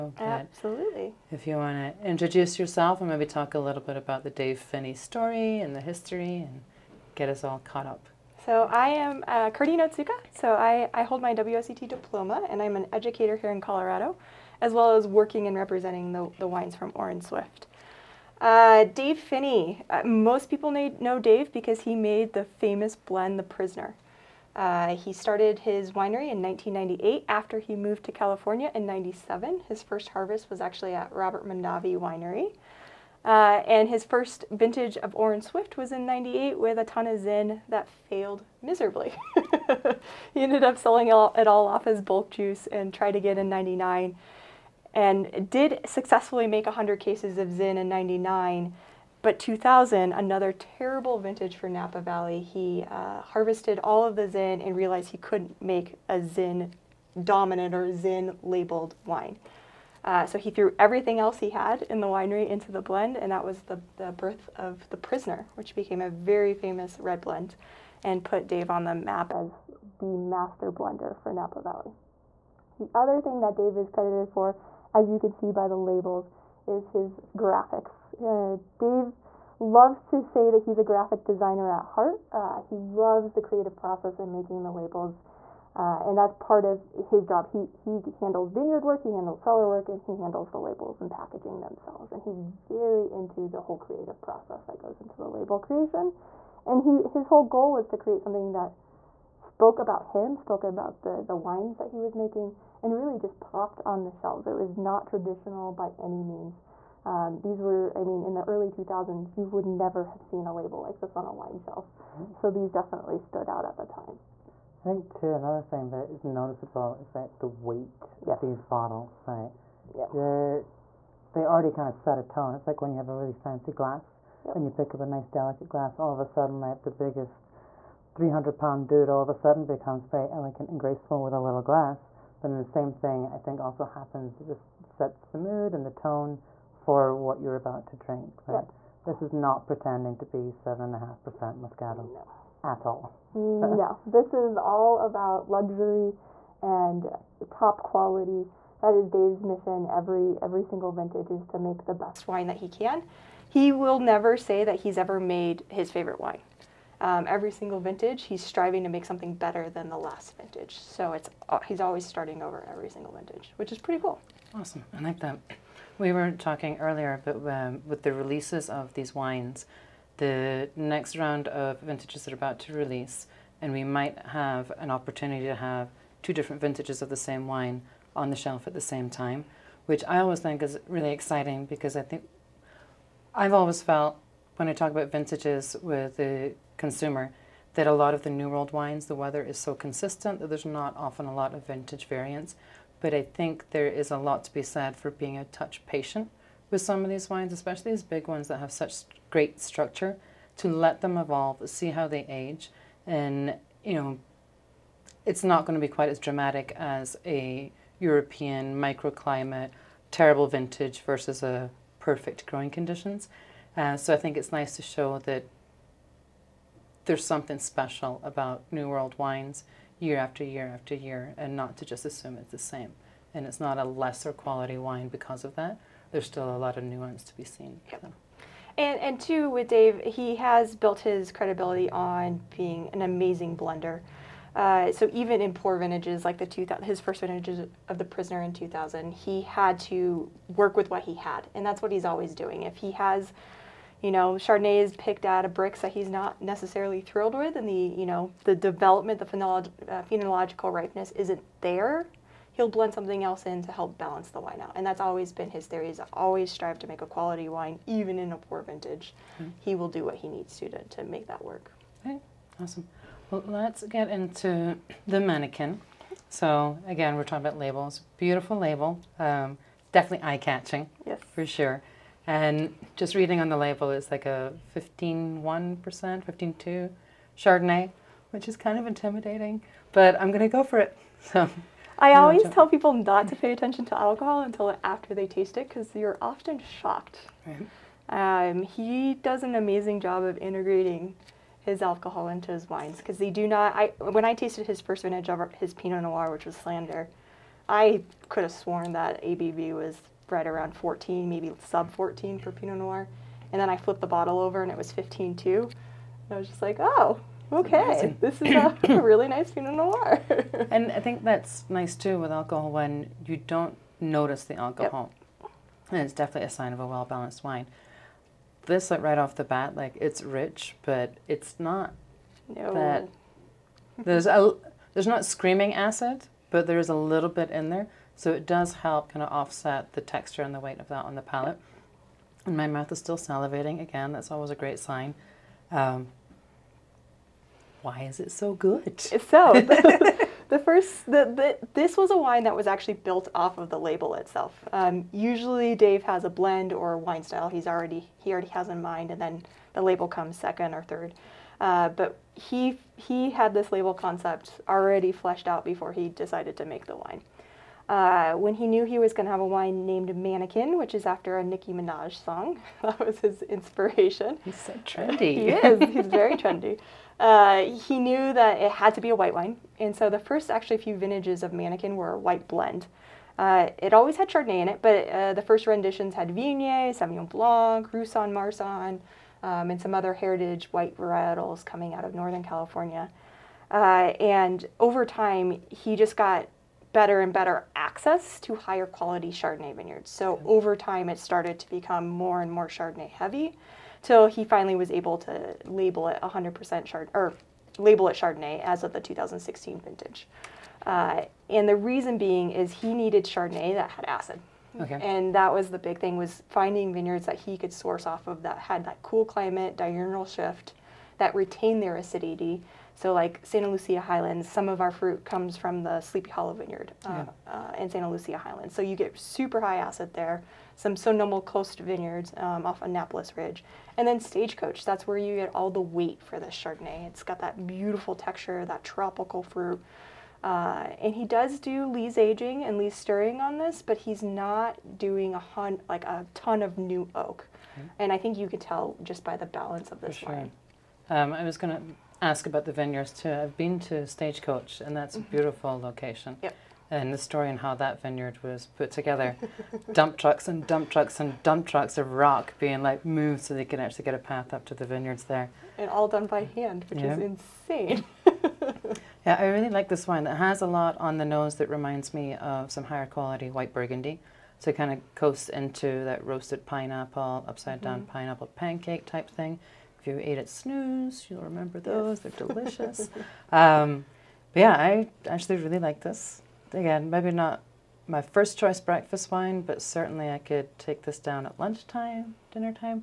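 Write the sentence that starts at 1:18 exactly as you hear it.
Uh, Dave loves to say that he's a graphic designer at heart.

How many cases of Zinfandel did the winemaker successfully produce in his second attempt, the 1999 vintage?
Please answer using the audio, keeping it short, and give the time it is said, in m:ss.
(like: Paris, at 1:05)
100, at 0:46.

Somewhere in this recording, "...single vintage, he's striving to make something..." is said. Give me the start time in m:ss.
2:37.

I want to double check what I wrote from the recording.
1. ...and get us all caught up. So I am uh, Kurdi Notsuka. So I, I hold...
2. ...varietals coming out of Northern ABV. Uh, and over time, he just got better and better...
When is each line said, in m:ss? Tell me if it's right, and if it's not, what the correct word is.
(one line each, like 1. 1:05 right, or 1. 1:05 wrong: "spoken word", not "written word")
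1. 0:06 right
2. 6:20 wrong: "California", not "ABV".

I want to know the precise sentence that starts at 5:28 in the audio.
So it does help kind of offset the texture and the weight of that on the palate.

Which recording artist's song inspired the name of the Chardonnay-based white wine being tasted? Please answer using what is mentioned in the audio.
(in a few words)
Nicki Minaj.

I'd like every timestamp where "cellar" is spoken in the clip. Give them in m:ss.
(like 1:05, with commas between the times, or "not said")
1:29.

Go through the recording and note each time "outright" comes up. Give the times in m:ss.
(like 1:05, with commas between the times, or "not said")
not said.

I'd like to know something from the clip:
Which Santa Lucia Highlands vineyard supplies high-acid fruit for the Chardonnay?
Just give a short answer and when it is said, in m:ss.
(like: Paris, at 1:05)
Sleepy Hollow Vineyard, at 6:56.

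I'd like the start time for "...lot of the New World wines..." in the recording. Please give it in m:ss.
3:07.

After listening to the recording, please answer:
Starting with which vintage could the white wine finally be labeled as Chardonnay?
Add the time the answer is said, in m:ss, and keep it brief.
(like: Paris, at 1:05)
2016, at 6:39.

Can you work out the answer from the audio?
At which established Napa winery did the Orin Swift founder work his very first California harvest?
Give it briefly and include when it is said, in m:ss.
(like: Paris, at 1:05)
Robert Mondavi Winery, at 0:31.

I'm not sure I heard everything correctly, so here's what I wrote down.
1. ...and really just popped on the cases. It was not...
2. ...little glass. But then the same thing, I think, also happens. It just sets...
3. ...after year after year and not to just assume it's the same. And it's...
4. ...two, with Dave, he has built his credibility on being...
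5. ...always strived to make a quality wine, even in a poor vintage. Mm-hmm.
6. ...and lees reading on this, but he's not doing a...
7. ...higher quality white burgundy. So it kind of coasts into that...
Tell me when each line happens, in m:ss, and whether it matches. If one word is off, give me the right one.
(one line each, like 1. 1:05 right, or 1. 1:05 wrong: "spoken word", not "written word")
1. 1:42 wrong: "shelves", not "cases"
2. 2:11 right
3. 3:40 right
4. 3:49 right
5. 4:16 right
6. 7:12 wrong: "stirring", not "reading"
7. 7:42 right.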